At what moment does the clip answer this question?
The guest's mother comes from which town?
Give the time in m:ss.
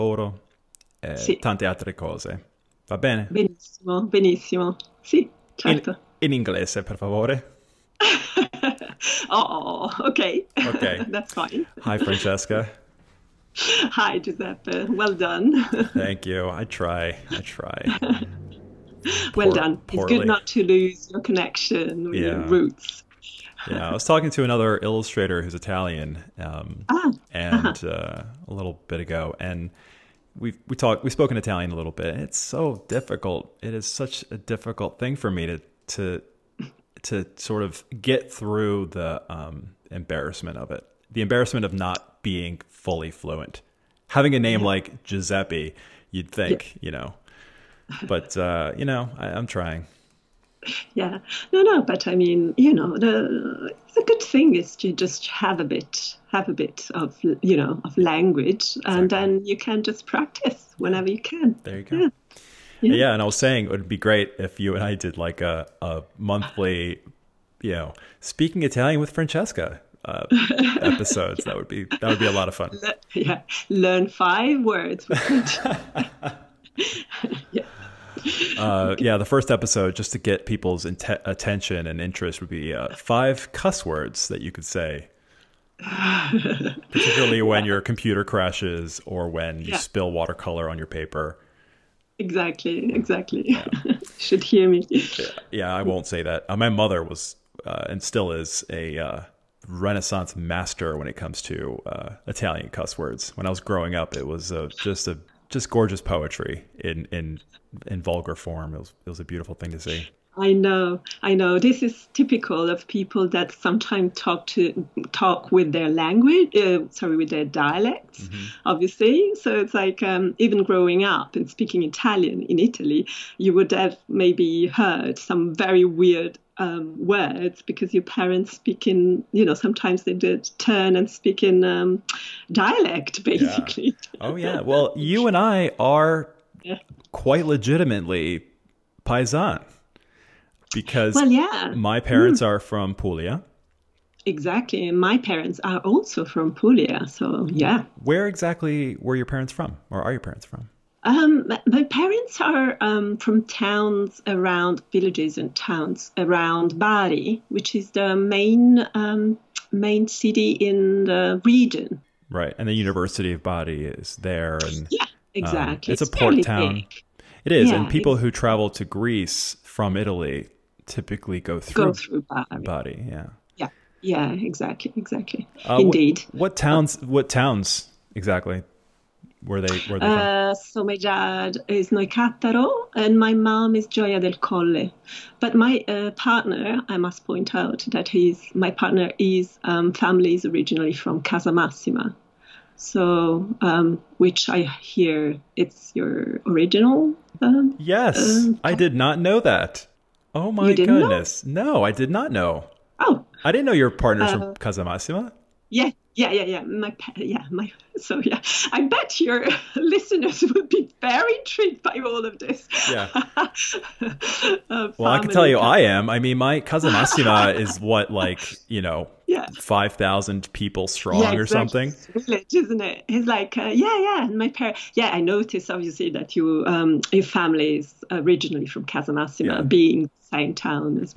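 3:03.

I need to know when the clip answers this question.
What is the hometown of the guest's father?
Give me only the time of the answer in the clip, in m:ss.
3:01.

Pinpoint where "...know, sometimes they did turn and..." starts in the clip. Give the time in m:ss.
2:09.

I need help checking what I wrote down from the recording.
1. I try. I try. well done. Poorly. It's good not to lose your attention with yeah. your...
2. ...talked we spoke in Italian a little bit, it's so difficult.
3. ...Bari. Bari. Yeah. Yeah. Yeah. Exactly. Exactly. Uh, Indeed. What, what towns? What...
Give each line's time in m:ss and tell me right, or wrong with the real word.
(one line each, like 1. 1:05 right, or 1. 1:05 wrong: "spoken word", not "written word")
1. 0:16 wrong: "connection", not "attention"
2. 0:30 right
3. 2:52 right.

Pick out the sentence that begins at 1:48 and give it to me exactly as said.
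It was it was a beautiful thing to see.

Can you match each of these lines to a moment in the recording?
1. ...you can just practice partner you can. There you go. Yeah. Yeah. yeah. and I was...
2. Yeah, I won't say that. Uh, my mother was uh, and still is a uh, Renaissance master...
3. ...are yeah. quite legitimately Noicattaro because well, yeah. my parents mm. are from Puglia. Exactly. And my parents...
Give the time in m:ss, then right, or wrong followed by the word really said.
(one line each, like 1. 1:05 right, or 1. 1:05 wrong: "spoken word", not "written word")
1. 0:59 wrong: "whenever", not "partner"
2. 1:35 right
3. 2:15 wrong: "Paisan", not "Noicattaro".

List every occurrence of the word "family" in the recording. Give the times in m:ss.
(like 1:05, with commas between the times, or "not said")
3:09, 3:47.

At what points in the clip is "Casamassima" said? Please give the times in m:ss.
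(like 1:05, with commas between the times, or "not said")
3:11, 3:24, 3:48.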